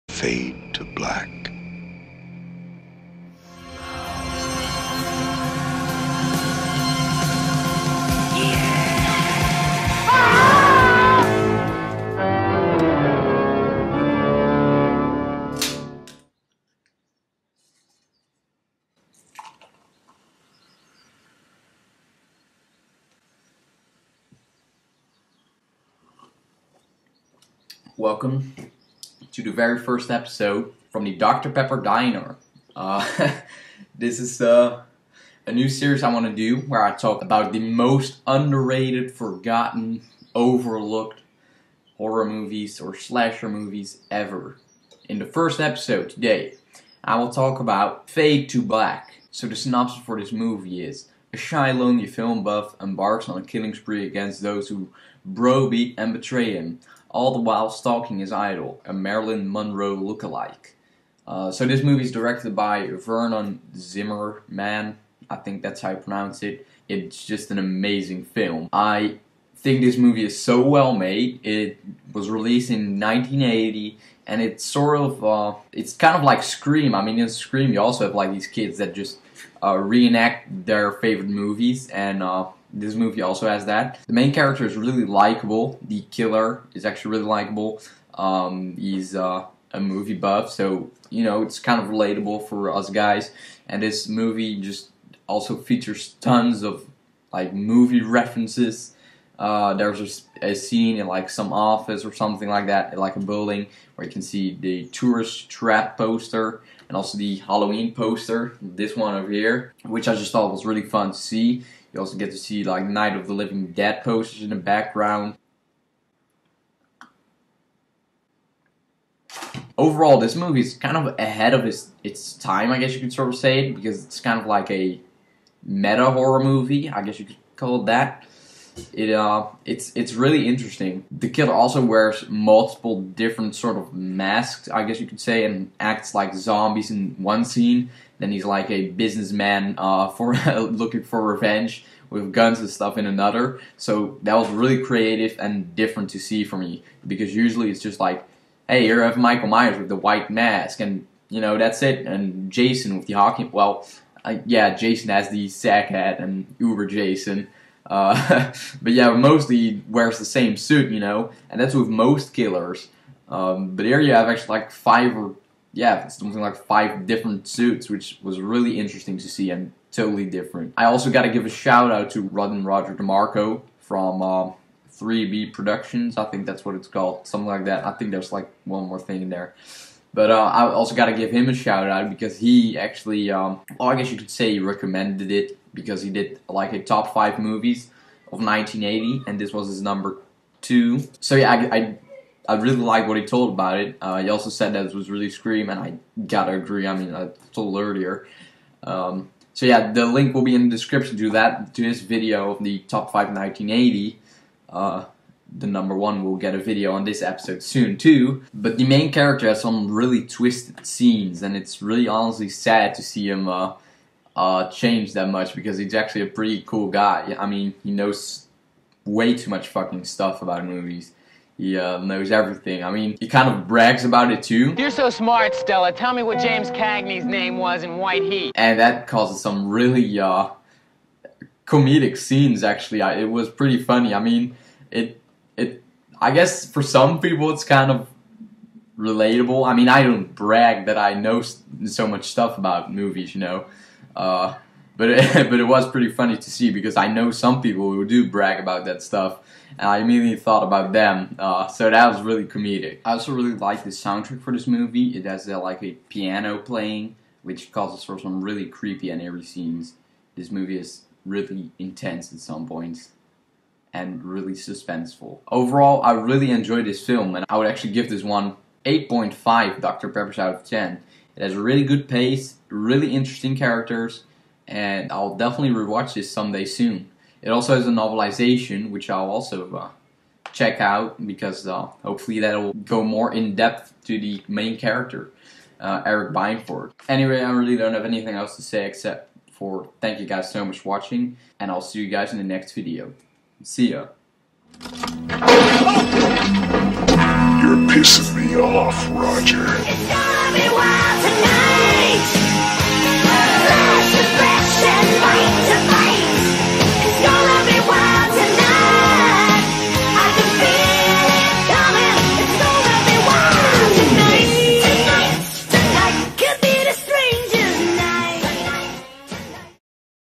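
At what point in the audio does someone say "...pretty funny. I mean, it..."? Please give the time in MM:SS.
03:53.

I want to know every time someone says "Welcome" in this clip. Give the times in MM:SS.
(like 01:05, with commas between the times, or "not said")
00:27.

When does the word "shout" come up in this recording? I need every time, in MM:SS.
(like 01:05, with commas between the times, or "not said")
02:51, 03:01.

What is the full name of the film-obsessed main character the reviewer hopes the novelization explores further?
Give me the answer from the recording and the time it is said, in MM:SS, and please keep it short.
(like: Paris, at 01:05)
Eric Binford, at 04:46.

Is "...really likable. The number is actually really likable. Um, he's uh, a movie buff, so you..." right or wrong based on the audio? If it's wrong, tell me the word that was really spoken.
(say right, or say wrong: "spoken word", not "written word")
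wrong: "killer", not "number".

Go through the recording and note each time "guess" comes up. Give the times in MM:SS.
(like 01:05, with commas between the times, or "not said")
02:02, 02:07, 02:14, 03:03, 03:56.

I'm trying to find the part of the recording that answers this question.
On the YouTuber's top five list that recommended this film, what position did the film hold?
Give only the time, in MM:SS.
03:09.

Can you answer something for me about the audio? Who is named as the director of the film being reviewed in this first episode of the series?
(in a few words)
Vernon Zimmerman.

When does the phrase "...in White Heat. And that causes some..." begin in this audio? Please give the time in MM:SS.
03:47.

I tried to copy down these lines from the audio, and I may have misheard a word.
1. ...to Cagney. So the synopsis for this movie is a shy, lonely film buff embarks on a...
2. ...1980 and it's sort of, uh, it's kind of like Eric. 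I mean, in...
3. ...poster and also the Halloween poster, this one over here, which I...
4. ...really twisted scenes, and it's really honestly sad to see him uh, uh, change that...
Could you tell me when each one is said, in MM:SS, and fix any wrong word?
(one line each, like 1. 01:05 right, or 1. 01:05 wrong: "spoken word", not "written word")
1. 00:48 wrong: "Black", not "Cagney"
2. 01:12 wrong: "Scream", not "Eric"
3. 01:45 right
4. 03:29 right.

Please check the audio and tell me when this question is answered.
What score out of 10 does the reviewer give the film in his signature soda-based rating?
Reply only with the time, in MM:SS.
04:28.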